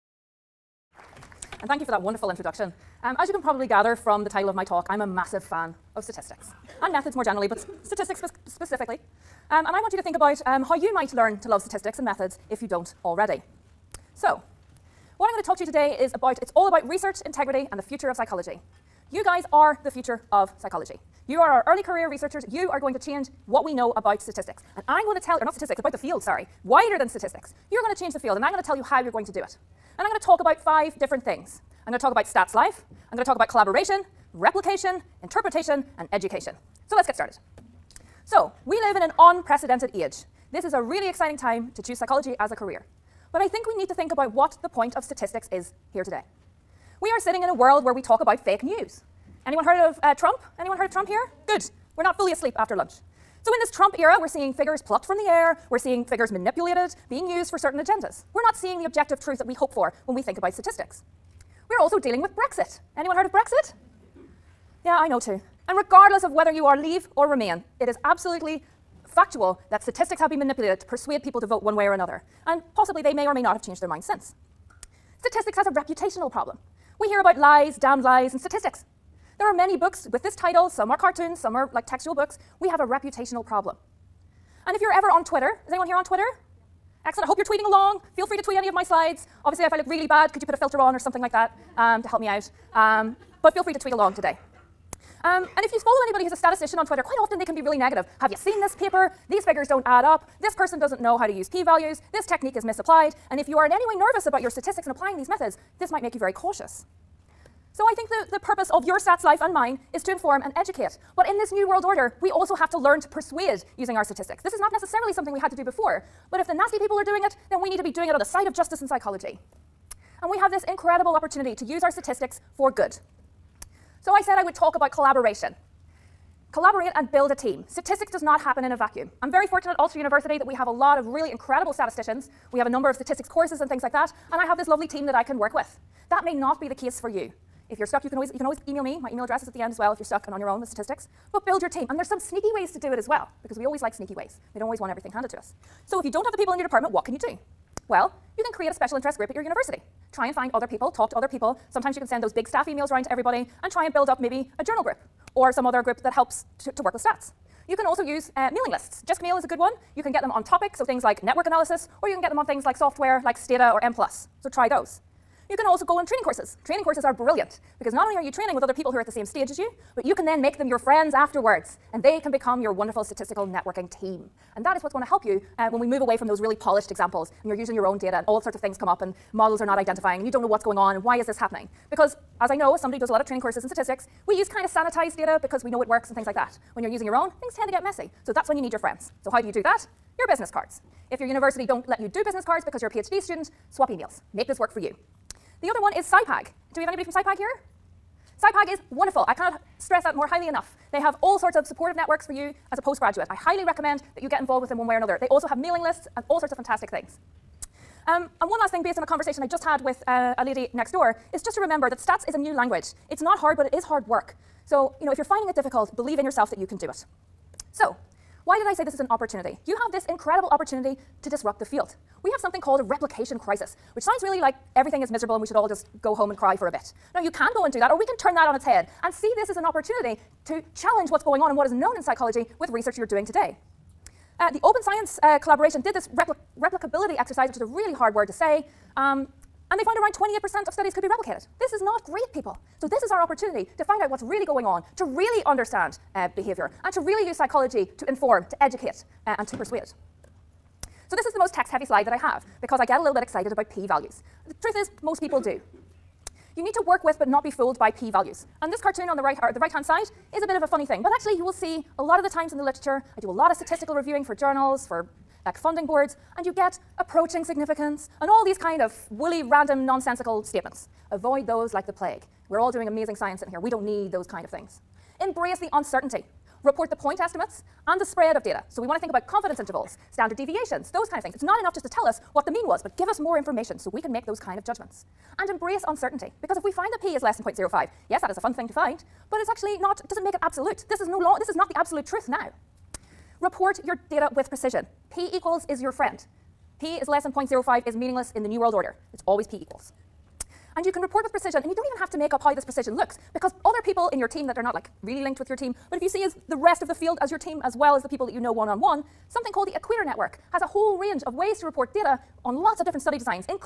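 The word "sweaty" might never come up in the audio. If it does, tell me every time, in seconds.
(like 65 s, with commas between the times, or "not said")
not said.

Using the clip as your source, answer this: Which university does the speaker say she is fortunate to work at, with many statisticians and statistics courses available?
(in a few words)
Ulster University.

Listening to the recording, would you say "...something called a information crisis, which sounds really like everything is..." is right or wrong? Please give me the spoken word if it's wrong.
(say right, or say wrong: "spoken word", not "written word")
wrong: "replication", not "information".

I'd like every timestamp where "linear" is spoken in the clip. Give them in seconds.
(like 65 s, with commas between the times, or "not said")
not said.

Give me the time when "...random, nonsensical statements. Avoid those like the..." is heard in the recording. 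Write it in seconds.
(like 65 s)
269 s.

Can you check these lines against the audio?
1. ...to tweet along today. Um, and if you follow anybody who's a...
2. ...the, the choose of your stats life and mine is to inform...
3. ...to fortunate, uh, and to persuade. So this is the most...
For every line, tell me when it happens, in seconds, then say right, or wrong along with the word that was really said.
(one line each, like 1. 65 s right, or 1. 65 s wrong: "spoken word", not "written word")
1. 93 s right
2. 108 s wrong: "purpose", not "choose"
3. 248 s wrong: "educate", not "fortunate".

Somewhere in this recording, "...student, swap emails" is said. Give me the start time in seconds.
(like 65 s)
193 s.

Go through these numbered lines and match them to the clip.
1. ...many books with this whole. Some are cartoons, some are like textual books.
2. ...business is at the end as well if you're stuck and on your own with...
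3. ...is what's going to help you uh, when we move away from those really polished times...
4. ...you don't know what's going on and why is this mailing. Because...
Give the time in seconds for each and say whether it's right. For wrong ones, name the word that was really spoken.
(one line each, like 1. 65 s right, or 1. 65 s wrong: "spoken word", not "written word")
1. 79 s wrong: "title", not "whole"
2. 139 s wrong: "address", not "business"
3. 174 s wrong: "examples", not "times"
4. 180 s wrong: "happening", not "mailing".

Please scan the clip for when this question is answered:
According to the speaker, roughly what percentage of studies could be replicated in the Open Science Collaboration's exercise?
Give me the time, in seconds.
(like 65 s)
240 s.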